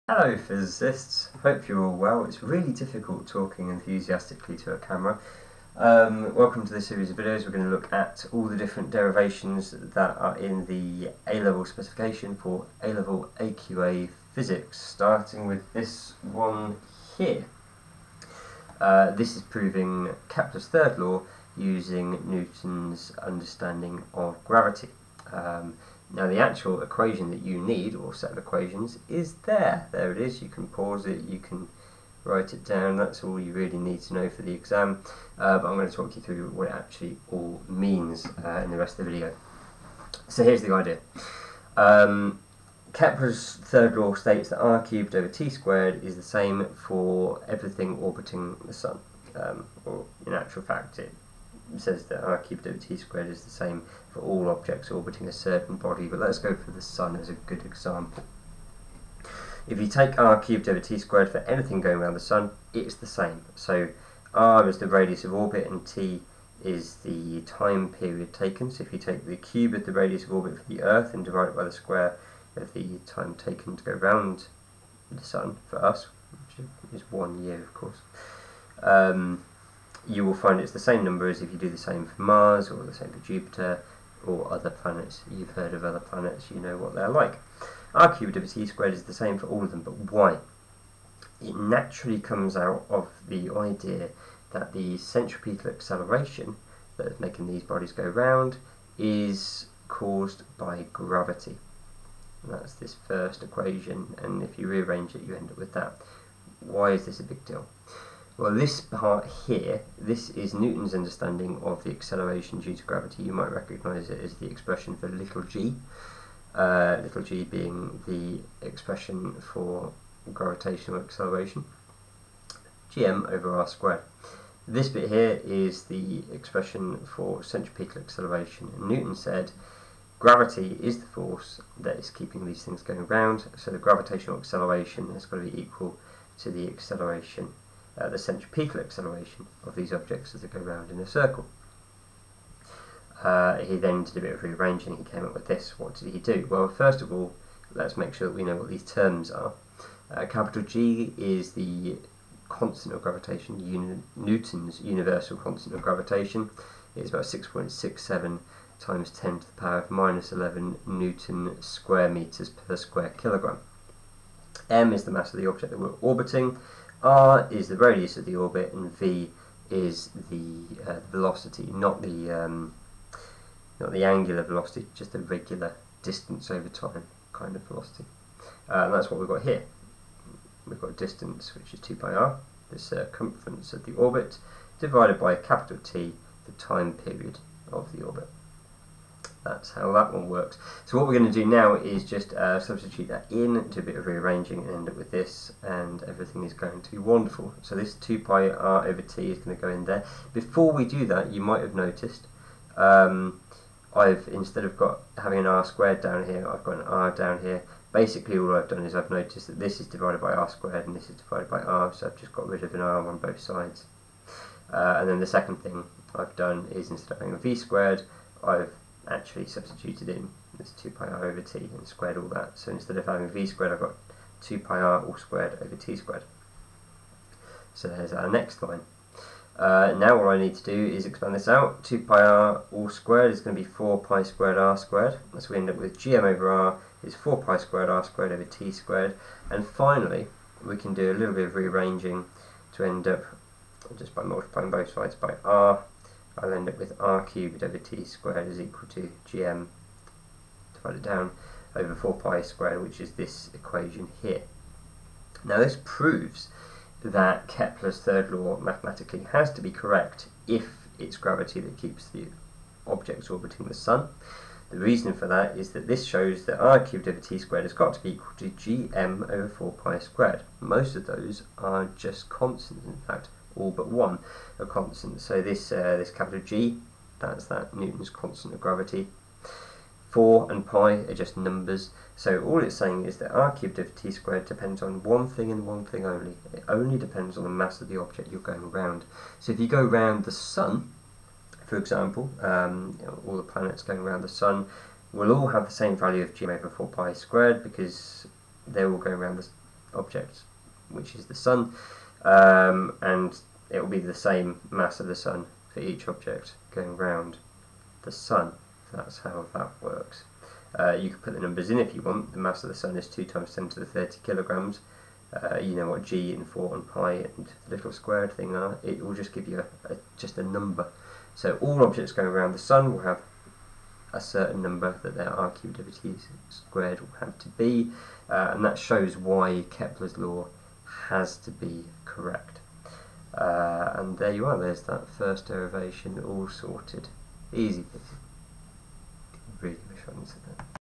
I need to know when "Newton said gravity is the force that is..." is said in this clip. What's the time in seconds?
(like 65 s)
128 s.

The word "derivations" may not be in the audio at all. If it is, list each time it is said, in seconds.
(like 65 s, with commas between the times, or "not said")
8 s, 335 s.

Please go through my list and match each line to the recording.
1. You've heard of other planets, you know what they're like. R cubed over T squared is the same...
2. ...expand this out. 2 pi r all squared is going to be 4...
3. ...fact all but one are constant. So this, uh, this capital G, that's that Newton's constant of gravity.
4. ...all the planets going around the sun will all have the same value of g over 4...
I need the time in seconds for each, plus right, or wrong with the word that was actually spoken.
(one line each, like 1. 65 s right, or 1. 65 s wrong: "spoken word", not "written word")
1. 85 s right
2. 231 s right
3. 273 s right
4. 293 s right.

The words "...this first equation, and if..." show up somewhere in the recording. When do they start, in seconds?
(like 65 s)
102 s.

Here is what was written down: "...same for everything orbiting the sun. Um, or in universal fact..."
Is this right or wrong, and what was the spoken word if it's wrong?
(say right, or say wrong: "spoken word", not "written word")
wrong: "actual", not "universal".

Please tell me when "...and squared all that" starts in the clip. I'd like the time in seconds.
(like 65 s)
221 s.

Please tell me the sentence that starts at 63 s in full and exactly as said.
So r is the radius of orbit and t is the time period taken.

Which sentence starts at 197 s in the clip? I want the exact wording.
So this 2 pi r over t is going to go in there.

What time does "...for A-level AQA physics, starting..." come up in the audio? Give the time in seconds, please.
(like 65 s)
12 s.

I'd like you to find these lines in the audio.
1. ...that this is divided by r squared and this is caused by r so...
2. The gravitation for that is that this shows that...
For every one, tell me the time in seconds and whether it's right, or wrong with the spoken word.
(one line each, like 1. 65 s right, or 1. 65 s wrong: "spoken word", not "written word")
1. 209 s wrong: "divided", not "caused"
2. 264 s wrong: "reason", not "gravitation".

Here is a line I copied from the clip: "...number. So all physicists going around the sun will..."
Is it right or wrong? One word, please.
wrong.